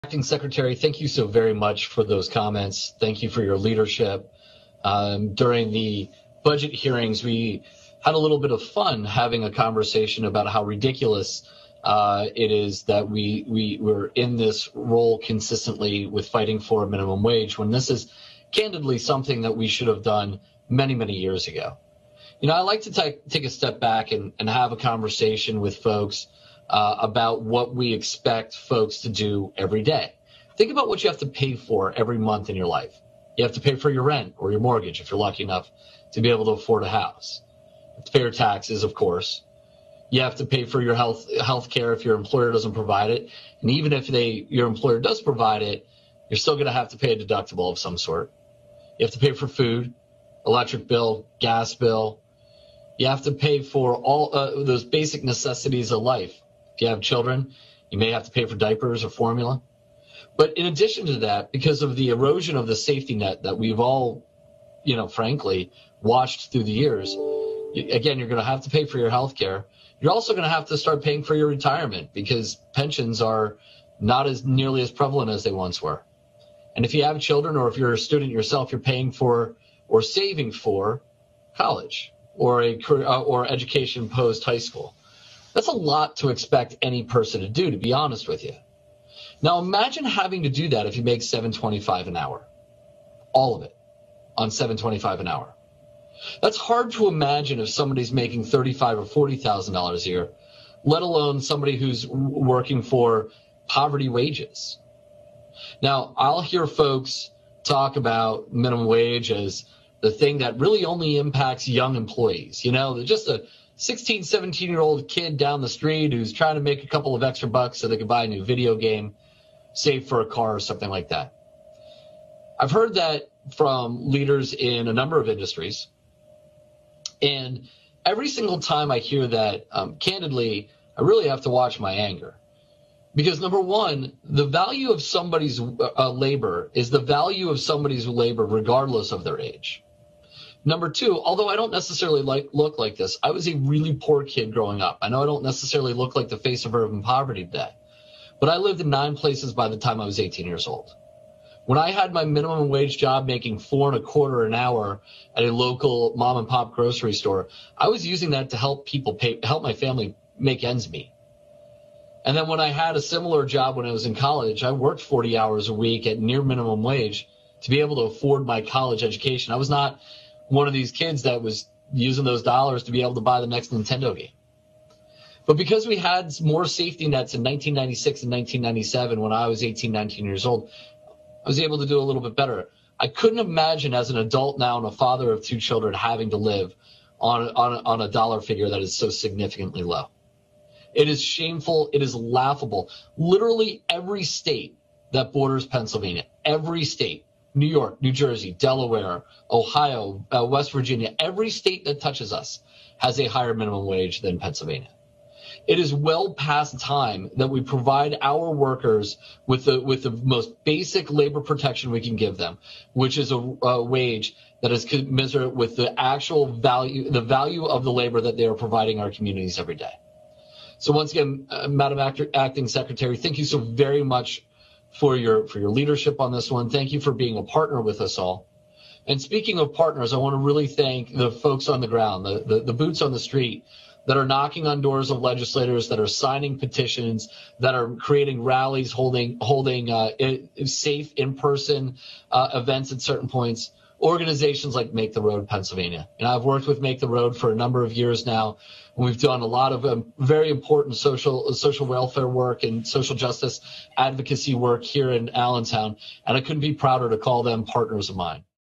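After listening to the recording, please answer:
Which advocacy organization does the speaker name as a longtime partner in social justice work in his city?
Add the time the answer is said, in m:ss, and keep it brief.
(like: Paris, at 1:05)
Make the Road Pennsylvania, at 4:04.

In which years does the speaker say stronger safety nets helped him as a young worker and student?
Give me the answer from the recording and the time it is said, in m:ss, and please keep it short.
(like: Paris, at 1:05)
1996 and 1997, at 2:57.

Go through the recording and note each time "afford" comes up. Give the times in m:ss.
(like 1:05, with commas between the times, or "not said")
0:36, 2:48.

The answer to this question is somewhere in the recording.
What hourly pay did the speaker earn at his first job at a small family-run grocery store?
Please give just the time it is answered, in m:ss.
2:33.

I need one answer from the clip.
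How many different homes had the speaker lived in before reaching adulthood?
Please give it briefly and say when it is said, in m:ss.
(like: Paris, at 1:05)
9, at 2:28.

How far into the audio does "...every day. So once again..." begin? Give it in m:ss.
3:39.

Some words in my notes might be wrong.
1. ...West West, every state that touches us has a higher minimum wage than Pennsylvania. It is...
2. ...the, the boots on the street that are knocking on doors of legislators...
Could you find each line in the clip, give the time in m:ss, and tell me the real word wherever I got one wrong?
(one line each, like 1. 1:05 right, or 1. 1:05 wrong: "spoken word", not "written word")
1. 3:20 wrong: "Virginia", not "West"
2. 3:52 right.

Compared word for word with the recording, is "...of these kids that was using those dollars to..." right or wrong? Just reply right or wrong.
right.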